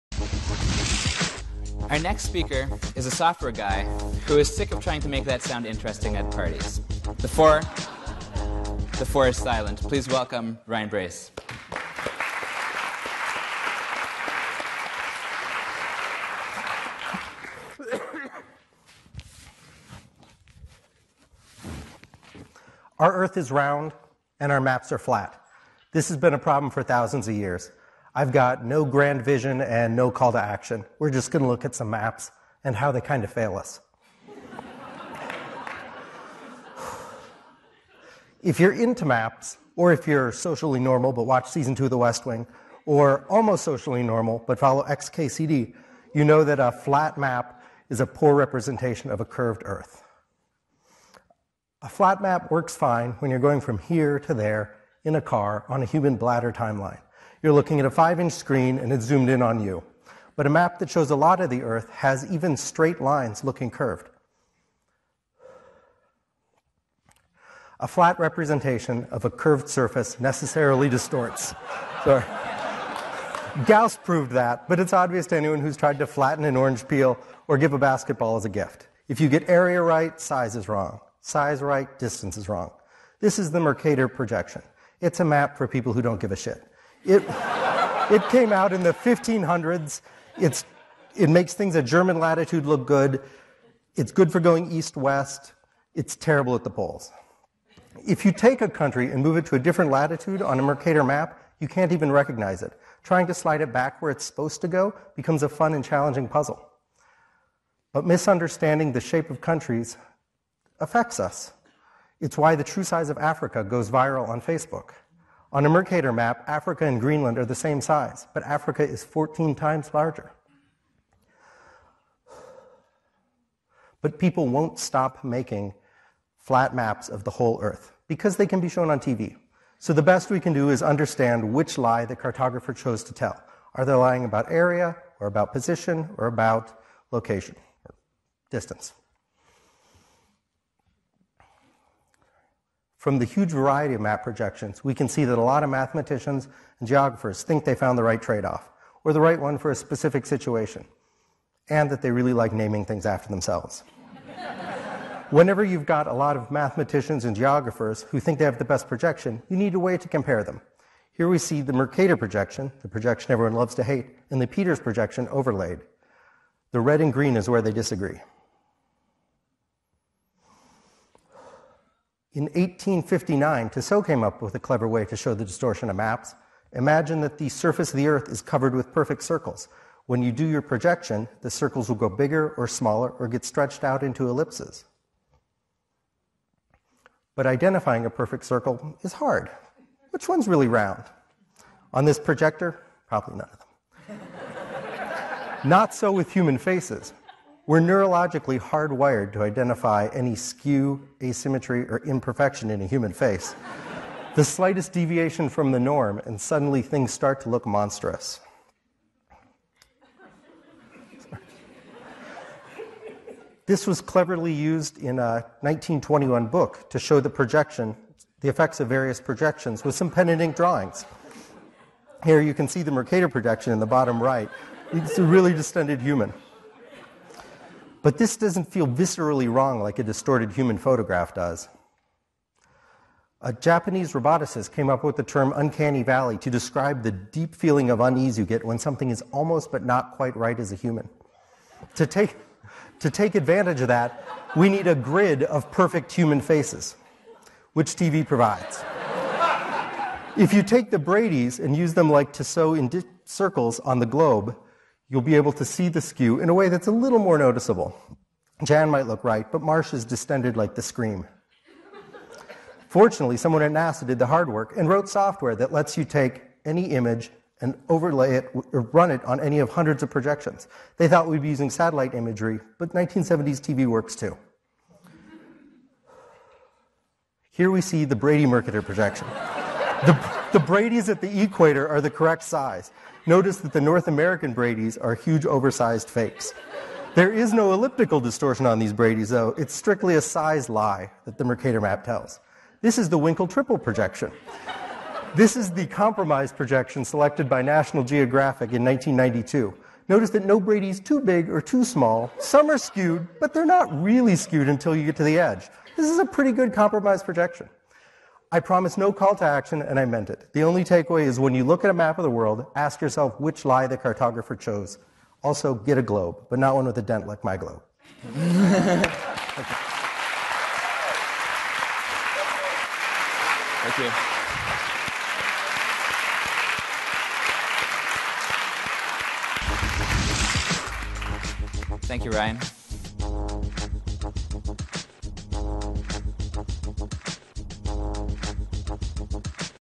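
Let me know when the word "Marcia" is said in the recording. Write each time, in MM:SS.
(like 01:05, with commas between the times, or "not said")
04:19.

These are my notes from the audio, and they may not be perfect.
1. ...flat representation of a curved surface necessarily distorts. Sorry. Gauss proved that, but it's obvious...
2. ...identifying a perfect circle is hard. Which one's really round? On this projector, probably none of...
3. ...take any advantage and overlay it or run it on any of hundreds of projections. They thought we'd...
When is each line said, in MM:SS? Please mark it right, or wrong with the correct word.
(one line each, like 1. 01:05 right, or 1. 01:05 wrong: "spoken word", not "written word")
1. 01:07 right
2. 03:07 right
3. 04:26 wrong: "image", not "advantage".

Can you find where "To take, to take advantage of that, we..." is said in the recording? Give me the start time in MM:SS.
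04:01.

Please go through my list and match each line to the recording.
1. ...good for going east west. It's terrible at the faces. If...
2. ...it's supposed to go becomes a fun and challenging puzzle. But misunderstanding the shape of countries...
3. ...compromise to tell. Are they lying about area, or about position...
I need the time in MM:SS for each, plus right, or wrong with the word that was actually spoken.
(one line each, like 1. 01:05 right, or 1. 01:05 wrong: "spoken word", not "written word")
1. 01:34 wrong: "poles", not "faces"
2. 01:44 right
3. 02:12 wrong: "chose", not "compromise".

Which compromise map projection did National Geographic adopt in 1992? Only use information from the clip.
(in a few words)
Winkel tripel.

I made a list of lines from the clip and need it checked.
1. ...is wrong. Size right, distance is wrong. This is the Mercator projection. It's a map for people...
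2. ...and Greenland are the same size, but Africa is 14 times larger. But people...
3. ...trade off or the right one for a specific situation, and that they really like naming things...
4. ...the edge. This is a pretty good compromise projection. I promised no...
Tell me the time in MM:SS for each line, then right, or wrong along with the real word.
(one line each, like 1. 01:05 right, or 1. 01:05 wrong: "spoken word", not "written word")
1. 01:20 right
2. 01:56 right
3. 02:28 right
4. 05:05 right.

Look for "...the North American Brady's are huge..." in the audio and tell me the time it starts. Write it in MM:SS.
04:43.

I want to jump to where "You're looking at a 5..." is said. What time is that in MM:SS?
00:57.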